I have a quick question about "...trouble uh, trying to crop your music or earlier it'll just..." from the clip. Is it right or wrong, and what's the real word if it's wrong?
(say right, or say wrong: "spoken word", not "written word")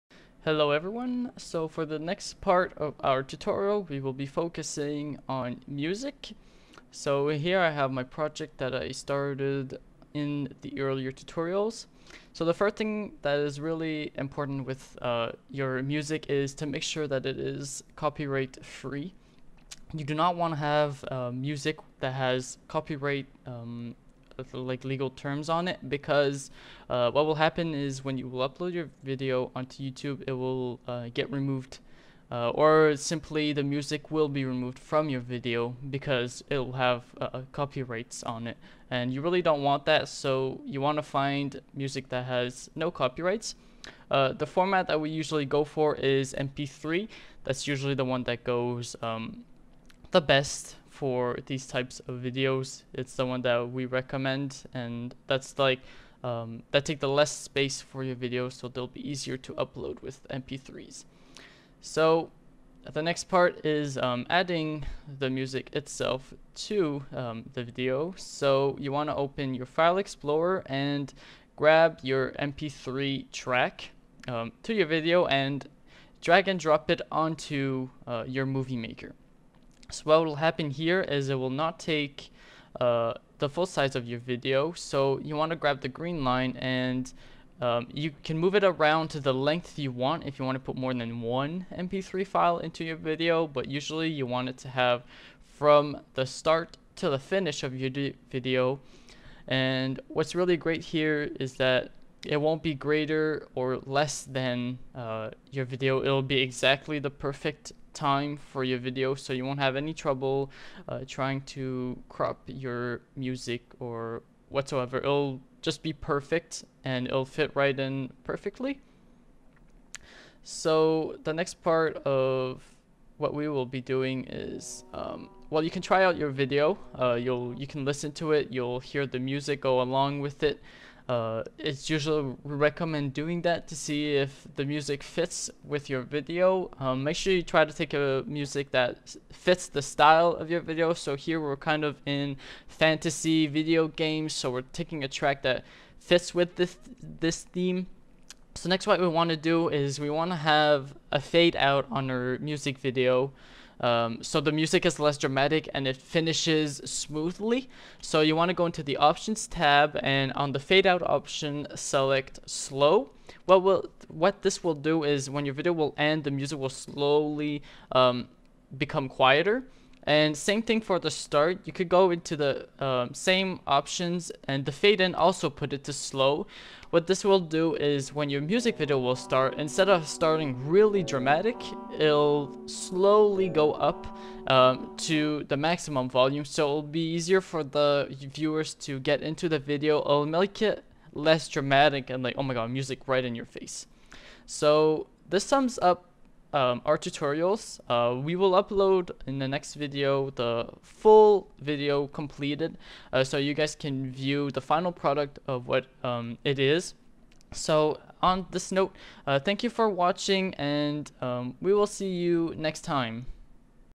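wrong: "whatsoever", not "earlier".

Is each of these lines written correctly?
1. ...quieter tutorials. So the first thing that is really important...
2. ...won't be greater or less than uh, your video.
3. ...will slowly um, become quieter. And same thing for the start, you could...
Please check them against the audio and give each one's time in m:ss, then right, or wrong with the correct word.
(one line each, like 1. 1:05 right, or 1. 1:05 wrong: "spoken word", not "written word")
1. 0:10 wrong: "earlier", not "quieter"
2. 1:42 right
3. 2:46 right.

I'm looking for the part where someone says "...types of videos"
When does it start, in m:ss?
0:51.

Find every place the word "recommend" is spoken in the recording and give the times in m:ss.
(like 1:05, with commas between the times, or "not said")
0:53, 2:12.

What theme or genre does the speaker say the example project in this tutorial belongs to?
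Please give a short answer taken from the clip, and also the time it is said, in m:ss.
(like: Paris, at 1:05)
fantasy video games, at 2:22.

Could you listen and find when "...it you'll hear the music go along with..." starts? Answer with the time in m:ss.
2:08.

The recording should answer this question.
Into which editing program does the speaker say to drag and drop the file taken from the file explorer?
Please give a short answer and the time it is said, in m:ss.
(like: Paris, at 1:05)
Movie Maker, at 1:18.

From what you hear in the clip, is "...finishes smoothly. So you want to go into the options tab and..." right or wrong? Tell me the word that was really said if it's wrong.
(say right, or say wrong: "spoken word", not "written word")
right.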